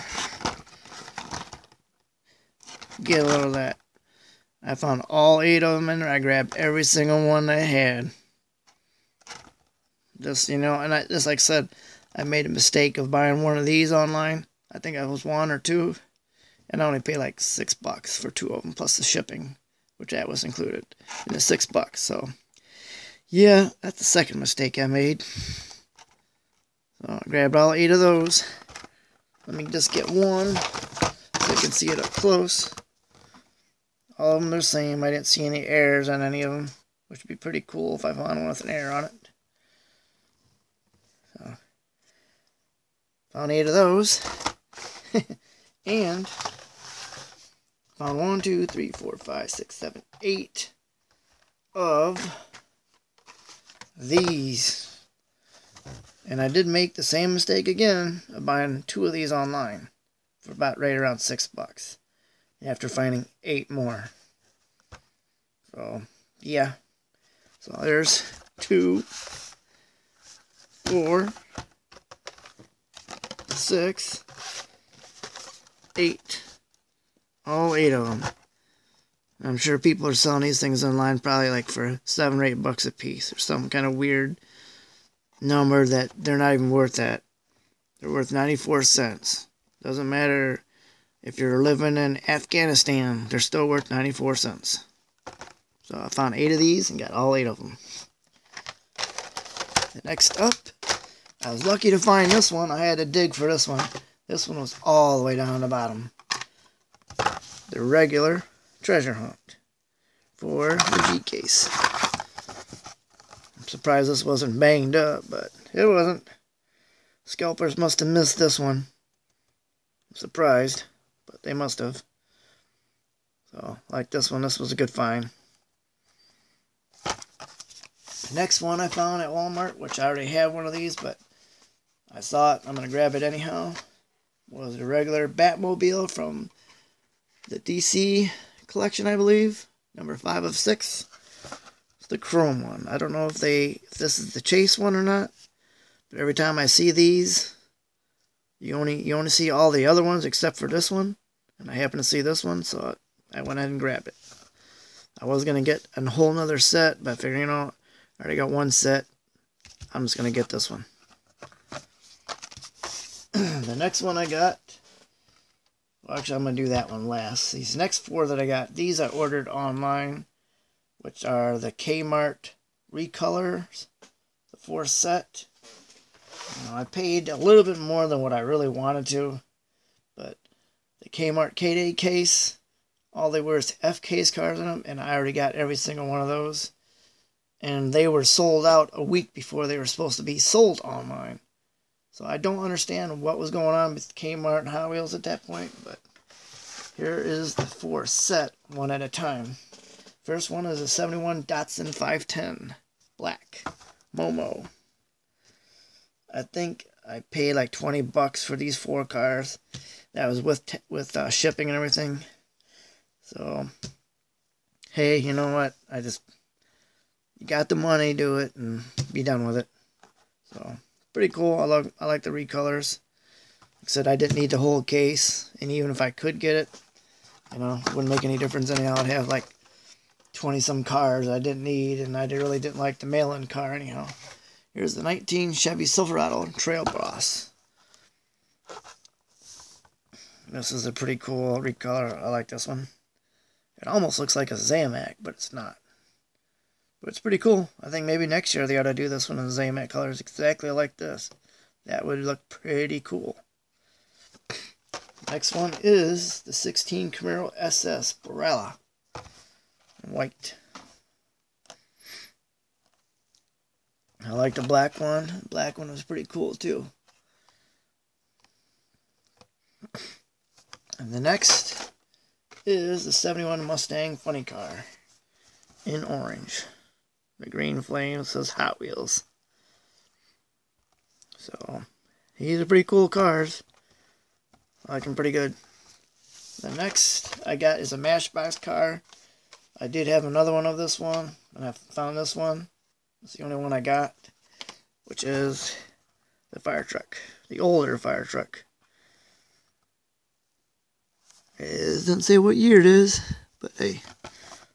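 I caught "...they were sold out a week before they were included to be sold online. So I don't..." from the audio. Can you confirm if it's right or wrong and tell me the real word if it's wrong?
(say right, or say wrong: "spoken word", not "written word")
wrong: "supposed", not "included".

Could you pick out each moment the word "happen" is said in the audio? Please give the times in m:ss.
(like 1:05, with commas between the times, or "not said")
2:31.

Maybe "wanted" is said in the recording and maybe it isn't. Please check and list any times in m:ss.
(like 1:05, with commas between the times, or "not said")
2:58.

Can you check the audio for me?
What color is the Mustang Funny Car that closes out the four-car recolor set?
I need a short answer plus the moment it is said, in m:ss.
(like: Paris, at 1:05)
Orange, at 4:36.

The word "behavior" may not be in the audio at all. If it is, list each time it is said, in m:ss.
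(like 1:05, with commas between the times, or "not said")
not said.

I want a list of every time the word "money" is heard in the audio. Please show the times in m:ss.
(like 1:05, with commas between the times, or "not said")
3:37.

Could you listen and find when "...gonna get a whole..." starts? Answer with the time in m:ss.
2:35.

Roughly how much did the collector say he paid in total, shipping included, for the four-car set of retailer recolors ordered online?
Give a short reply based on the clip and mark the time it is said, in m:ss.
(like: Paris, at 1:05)
20 bucks, at 3:27.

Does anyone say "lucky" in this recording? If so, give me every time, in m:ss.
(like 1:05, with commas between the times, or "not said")
1:41.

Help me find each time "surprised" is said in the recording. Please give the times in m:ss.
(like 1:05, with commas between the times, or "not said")
1:53, 2:00.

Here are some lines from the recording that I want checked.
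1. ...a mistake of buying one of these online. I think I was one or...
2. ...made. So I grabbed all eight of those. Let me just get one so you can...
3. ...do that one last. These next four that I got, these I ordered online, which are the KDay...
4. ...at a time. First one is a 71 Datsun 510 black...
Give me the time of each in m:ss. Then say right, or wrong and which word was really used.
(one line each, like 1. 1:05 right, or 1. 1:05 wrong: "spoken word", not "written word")
1. 0:12 right
2. 0:24 right
3. 2:46 wrong: "Kmart", not "KDay"
4. 3:18 right.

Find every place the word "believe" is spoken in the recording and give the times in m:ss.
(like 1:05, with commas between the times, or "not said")
2:19.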